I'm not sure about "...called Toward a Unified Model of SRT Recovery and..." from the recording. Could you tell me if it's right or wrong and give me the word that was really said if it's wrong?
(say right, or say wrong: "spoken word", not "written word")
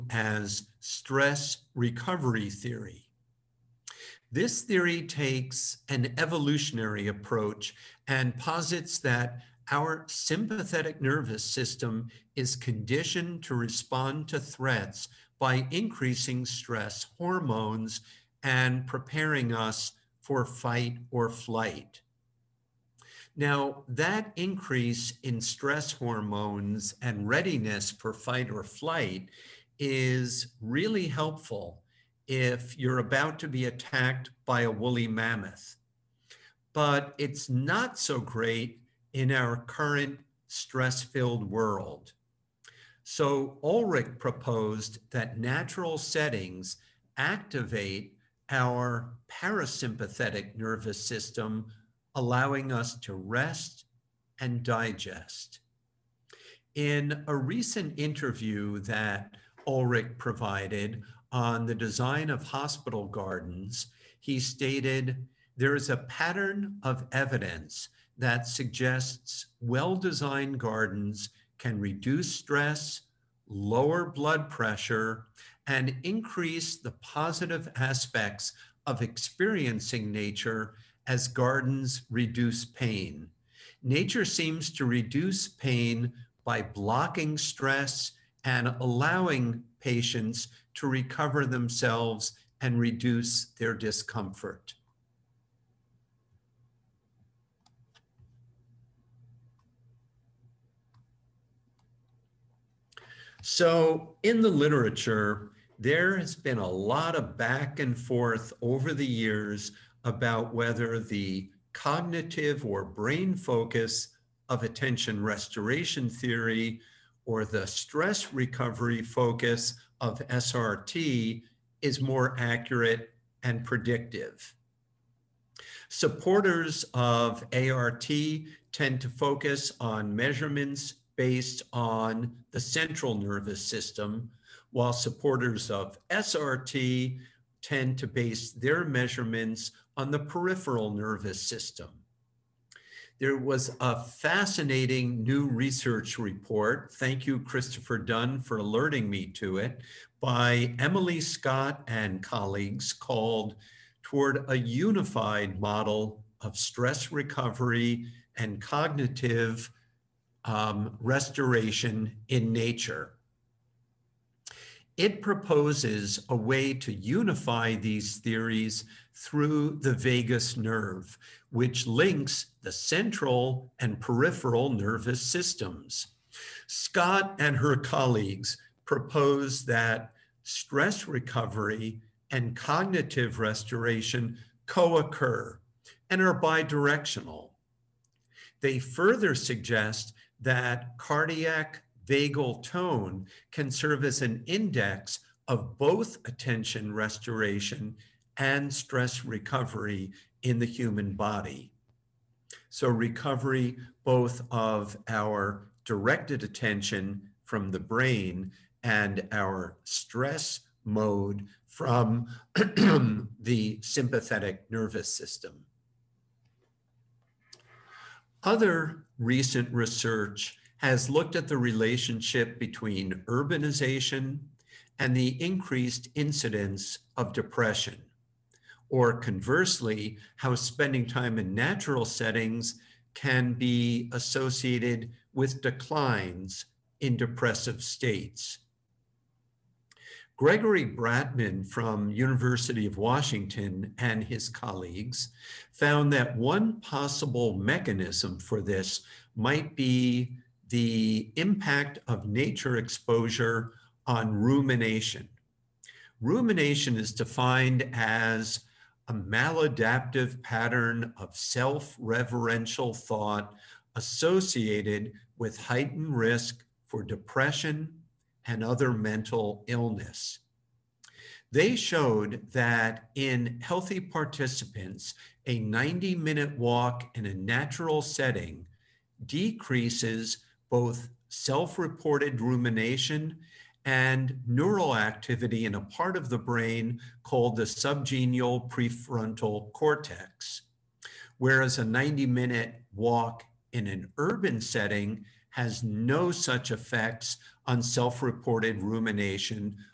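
wrong: "Stress", not "SRT".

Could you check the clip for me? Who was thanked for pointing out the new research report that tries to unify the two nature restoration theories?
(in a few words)
Christopher Dunn.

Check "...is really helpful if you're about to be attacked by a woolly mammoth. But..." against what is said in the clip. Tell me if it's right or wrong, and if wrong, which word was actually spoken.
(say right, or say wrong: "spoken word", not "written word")
right.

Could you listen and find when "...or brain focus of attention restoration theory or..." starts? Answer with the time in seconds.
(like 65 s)
112 s.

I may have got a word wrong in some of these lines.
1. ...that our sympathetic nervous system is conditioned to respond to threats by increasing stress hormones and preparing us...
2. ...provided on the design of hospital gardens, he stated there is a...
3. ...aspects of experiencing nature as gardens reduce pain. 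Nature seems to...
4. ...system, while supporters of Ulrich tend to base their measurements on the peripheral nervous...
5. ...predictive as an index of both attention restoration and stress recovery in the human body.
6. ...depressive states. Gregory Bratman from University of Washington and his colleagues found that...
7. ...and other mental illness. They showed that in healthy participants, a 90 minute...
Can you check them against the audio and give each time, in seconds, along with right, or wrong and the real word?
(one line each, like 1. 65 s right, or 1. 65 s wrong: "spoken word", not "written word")
1. 8 s right
2. 60 s right
3. 77 s right
4. 133 s wrong: "SRT", not "Ulrich"
5. 193 s wrong: "serve", not "predictive"
6. 237 s right
7. 268 s right.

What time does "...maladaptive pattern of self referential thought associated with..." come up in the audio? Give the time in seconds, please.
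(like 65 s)
259 s.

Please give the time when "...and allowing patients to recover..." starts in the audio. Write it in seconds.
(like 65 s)
88 s.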